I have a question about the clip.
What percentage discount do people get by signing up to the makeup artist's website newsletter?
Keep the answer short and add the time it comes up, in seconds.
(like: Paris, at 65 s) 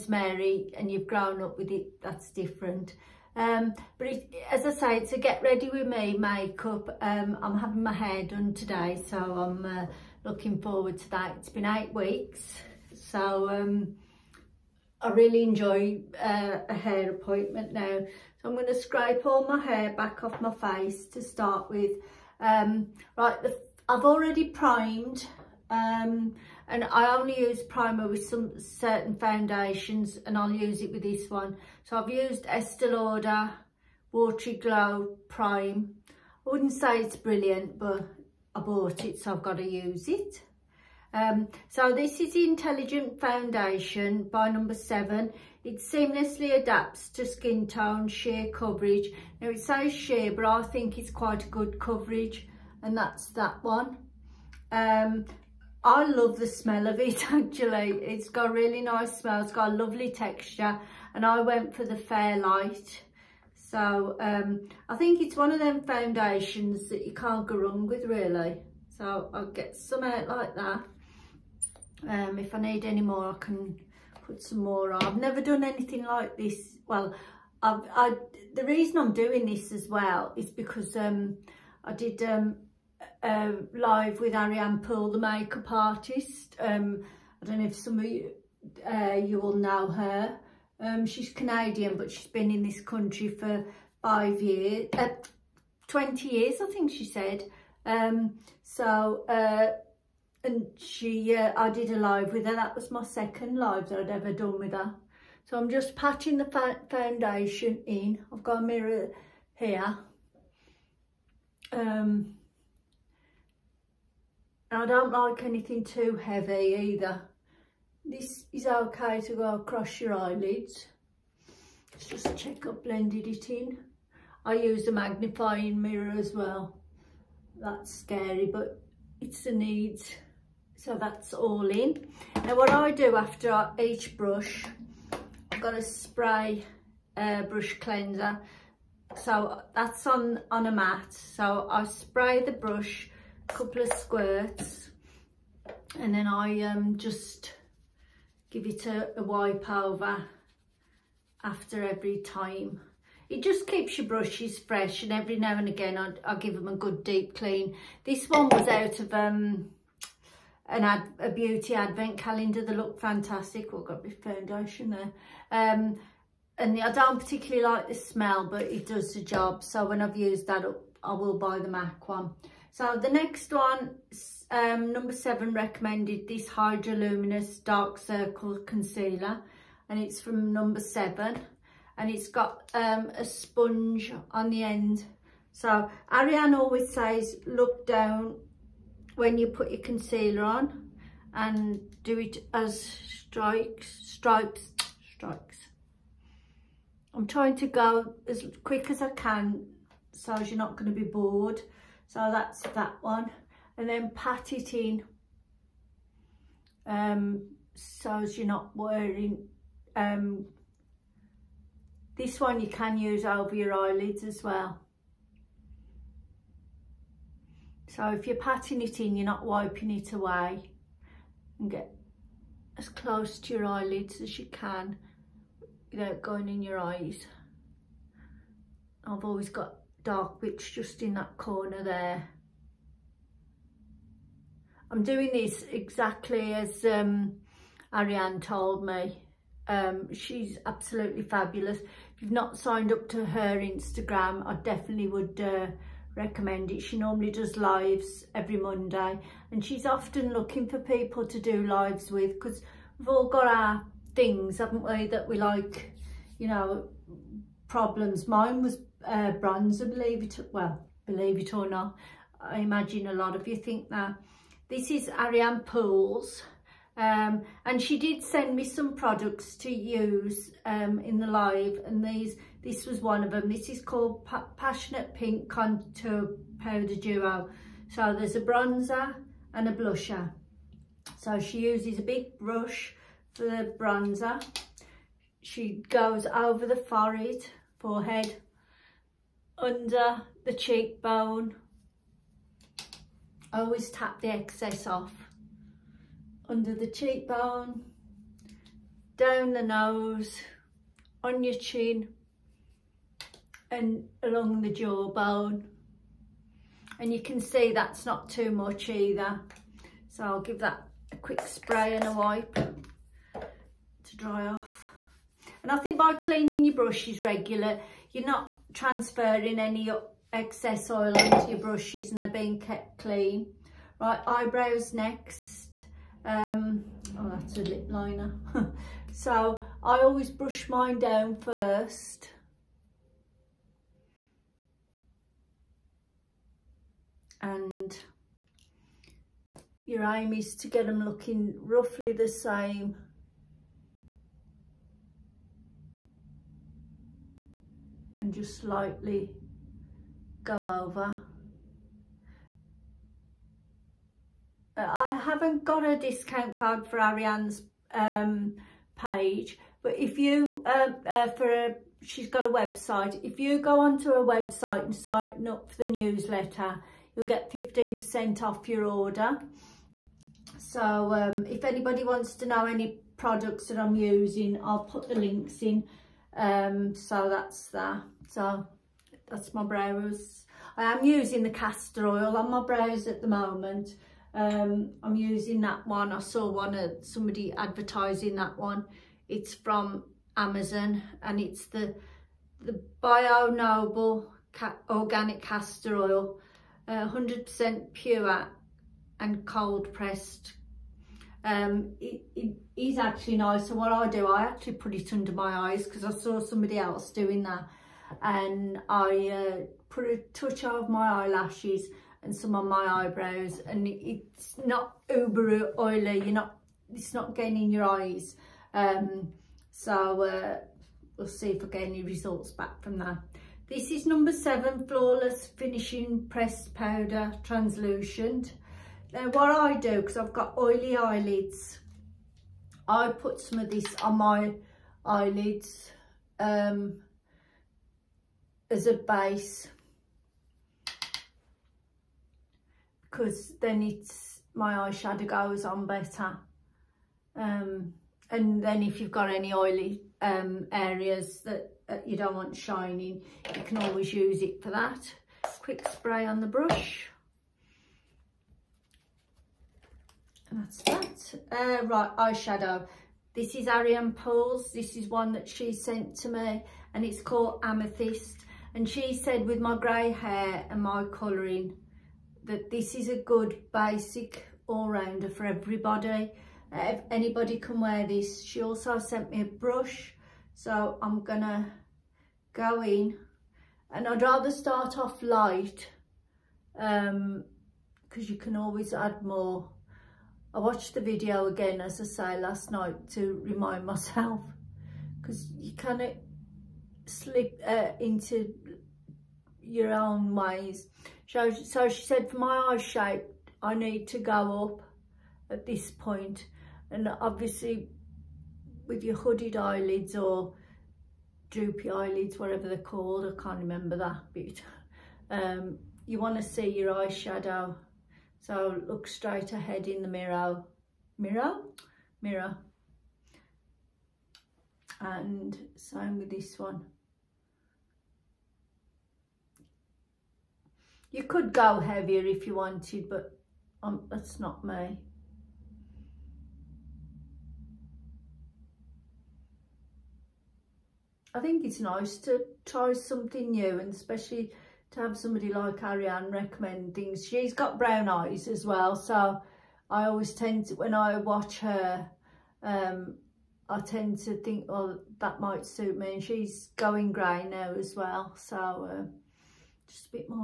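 15%, at 367 s.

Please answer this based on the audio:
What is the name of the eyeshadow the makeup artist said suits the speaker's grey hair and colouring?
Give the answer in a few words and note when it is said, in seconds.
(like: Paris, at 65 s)
Amethyst, at 467 s.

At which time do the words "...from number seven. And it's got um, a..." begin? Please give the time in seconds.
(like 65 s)
180 s.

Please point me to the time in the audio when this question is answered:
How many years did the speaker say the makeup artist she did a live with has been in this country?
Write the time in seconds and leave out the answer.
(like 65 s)
95 s.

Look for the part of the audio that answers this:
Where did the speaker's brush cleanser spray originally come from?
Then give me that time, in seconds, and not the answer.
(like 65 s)
161 s.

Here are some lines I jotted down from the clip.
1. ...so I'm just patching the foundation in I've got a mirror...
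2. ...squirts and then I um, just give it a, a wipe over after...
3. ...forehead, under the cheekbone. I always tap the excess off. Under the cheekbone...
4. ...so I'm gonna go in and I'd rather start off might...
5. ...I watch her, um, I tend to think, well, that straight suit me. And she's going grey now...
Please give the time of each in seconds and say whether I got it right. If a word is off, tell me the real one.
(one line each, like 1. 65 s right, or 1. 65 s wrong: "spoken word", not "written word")
1. 105 s right
2. 143 s right
3. 287 s right
4. 480 s wrong: "light", not "might"
5. 550 s wrong: "might", not "straight".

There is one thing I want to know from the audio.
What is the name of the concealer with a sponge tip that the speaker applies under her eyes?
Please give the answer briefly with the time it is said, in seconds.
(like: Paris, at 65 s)
Hydroluminous Dark Circle Concealer, at 176 s.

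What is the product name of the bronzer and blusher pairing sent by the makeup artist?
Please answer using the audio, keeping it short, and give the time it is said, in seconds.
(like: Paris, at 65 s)
Passionate Pink Contour Powder Duo, at 274 s.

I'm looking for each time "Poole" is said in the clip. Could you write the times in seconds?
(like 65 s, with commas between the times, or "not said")
84 s, 265 s, 464 s.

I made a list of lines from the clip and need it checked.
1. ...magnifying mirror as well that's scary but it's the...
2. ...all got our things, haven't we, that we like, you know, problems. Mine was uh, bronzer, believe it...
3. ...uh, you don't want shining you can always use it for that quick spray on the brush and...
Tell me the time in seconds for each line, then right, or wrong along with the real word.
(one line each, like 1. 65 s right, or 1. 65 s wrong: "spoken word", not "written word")
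1. 124 s right
2. 253 s right
3. 451 s right.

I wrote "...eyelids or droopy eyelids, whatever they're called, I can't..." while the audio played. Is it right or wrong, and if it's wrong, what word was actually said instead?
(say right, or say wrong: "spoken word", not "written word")
right.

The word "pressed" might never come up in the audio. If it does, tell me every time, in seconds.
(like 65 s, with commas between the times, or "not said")
399 s, 426 s.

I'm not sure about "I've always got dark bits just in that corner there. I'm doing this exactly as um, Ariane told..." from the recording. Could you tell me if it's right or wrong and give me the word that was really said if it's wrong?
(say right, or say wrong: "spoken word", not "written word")
right.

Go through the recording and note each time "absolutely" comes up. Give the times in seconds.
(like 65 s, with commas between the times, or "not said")
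240 s.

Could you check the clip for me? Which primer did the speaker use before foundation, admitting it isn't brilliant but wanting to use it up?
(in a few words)
Estee Lauder Watery Glow Prime.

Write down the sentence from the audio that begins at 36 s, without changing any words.
I wouldn't say it's brilliant, but I bought it, so I've got to use it.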